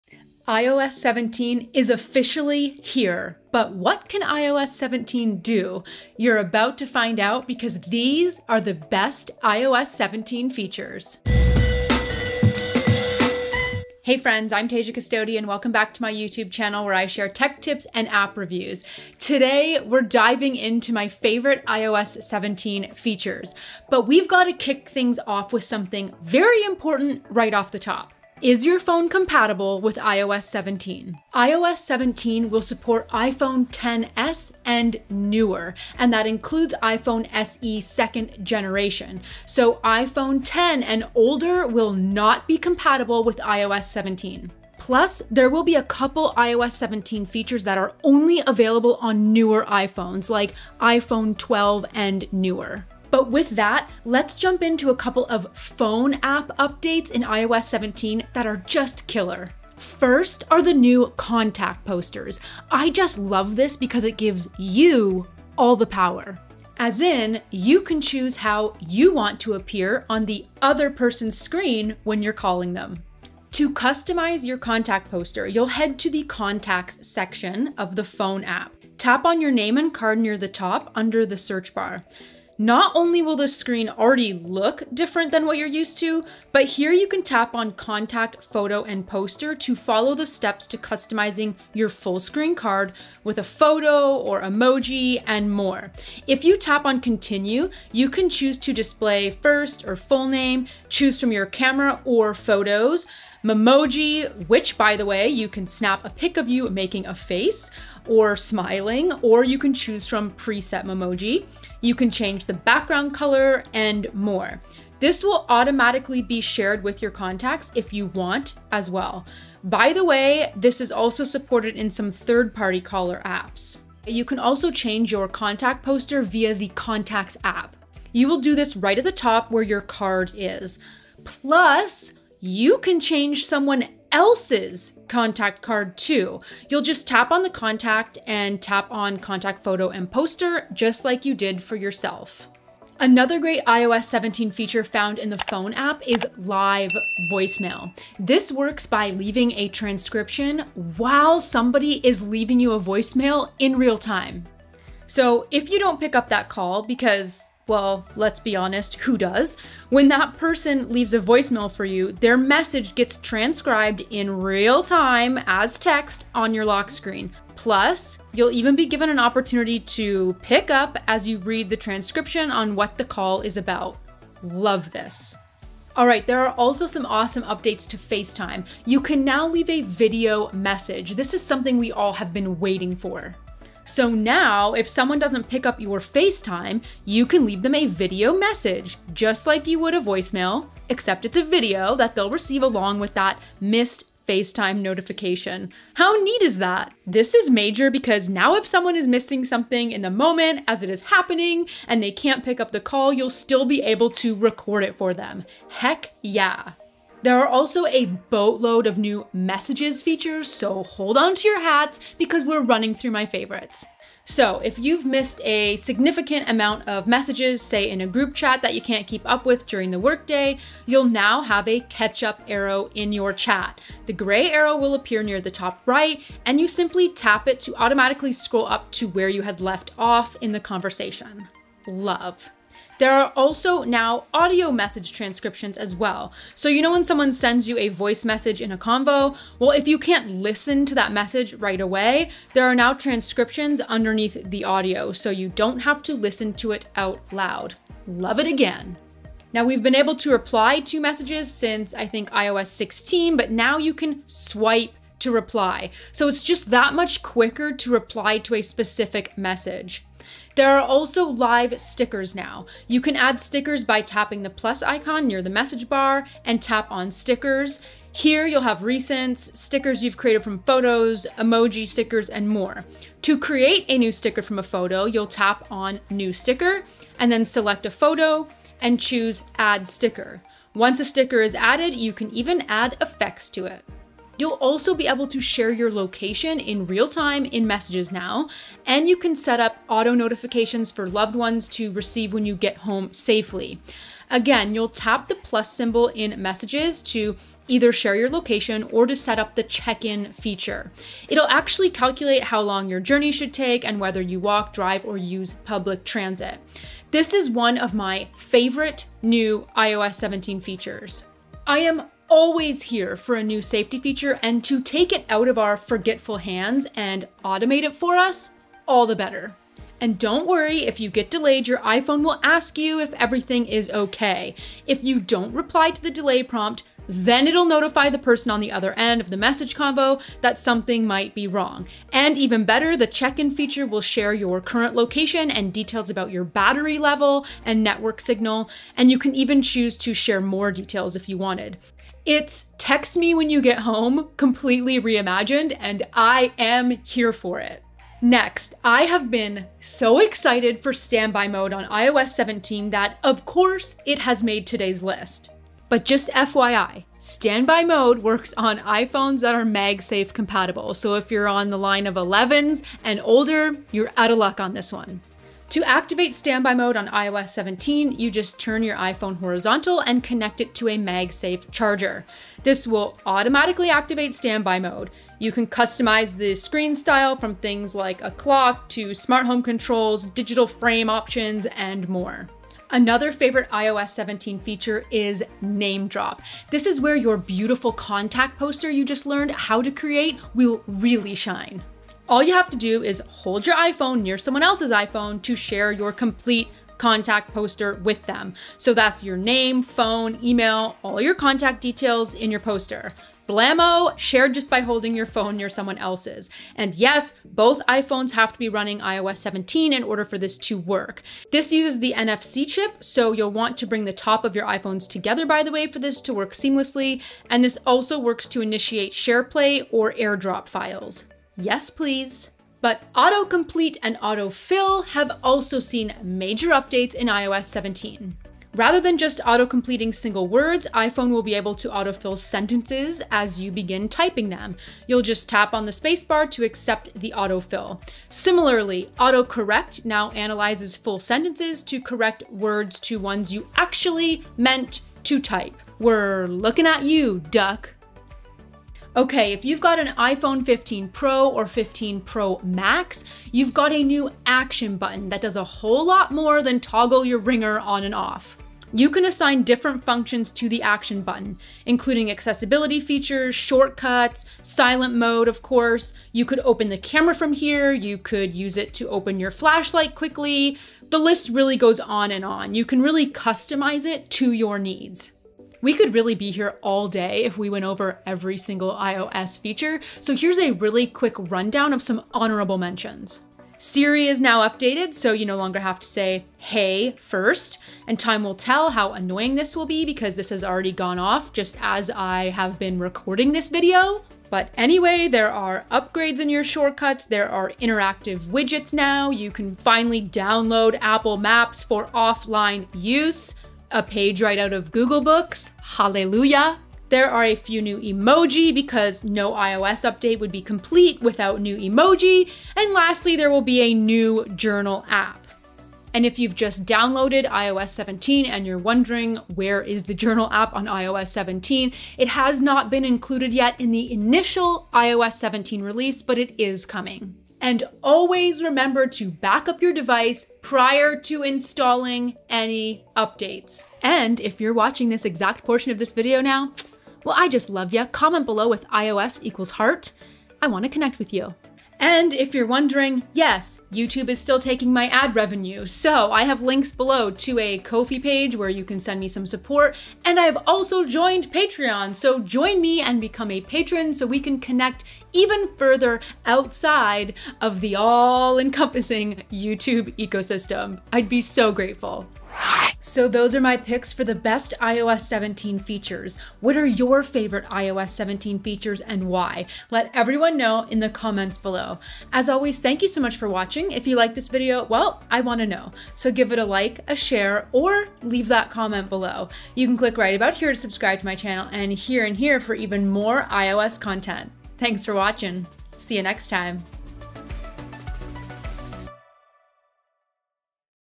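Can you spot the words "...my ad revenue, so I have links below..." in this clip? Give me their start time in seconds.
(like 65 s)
544 s.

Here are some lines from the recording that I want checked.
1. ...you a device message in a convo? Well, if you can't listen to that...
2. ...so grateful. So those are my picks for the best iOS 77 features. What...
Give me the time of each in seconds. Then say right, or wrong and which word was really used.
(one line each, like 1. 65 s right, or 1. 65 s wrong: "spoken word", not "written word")
1. 237 s wrong: "voice", not "device"
2. 561 s wrong: "17", not "77".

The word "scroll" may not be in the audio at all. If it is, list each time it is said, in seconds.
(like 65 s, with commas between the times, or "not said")
228 s.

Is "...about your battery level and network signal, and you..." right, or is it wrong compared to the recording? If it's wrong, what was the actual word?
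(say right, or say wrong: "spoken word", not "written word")
right.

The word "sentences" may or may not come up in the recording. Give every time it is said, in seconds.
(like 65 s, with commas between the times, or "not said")
432 s, 441 s.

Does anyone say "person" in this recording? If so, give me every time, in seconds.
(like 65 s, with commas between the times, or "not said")
70 s, 160 s, 328 s.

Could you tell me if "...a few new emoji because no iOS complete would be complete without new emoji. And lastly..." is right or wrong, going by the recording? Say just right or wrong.
wrong.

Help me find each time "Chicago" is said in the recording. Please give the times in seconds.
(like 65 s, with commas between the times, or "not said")
not said.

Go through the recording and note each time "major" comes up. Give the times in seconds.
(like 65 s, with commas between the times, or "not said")
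197 s, 426 s.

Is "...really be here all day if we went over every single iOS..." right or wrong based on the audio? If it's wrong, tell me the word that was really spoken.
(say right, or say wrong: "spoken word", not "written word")
right.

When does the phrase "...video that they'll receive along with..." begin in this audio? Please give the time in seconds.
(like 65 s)
191 s.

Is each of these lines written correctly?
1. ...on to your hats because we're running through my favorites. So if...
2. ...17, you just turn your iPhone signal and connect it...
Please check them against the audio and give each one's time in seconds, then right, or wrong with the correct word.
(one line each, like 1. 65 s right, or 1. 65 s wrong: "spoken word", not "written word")
1. 211 s right
2. 367 s wrong: "horizontal", not "signal".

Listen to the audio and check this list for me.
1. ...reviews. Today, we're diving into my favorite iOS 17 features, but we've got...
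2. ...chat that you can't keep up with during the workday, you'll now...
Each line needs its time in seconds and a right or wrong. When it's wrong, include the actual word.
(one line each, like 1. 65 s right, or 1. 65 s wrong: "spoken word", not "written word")
1. 18 s right
2. 218 s right.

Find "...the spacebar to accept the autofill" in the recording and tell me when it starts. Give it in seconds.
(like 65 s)
435 s.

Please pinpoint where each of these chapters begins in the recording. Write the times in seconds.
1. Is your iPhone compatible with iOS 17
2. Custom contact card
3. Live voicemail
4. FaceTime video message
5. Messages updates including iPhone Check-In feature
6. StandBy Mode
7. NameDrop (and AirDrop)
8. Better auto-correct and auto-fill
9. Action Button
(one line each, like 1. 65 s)
1. 23 s
2. 52 s
3. 142 s
4. 175 s
5. 206 s
6. 347 s
7. 382 s
8. 422 s
9. 448 s.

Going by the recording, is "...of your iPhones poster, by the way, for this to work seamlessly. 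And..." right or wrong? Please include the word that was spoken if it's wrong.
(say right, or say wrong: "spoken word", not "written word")
wrong: "together", not "poster".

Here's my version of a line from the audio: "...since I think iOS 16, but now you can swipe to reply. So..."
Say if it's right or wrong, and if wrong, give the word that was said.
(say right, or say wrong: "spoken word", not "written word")
right.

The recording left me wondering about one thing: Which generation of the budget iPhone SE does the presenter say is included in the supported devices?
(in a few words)
Second generation.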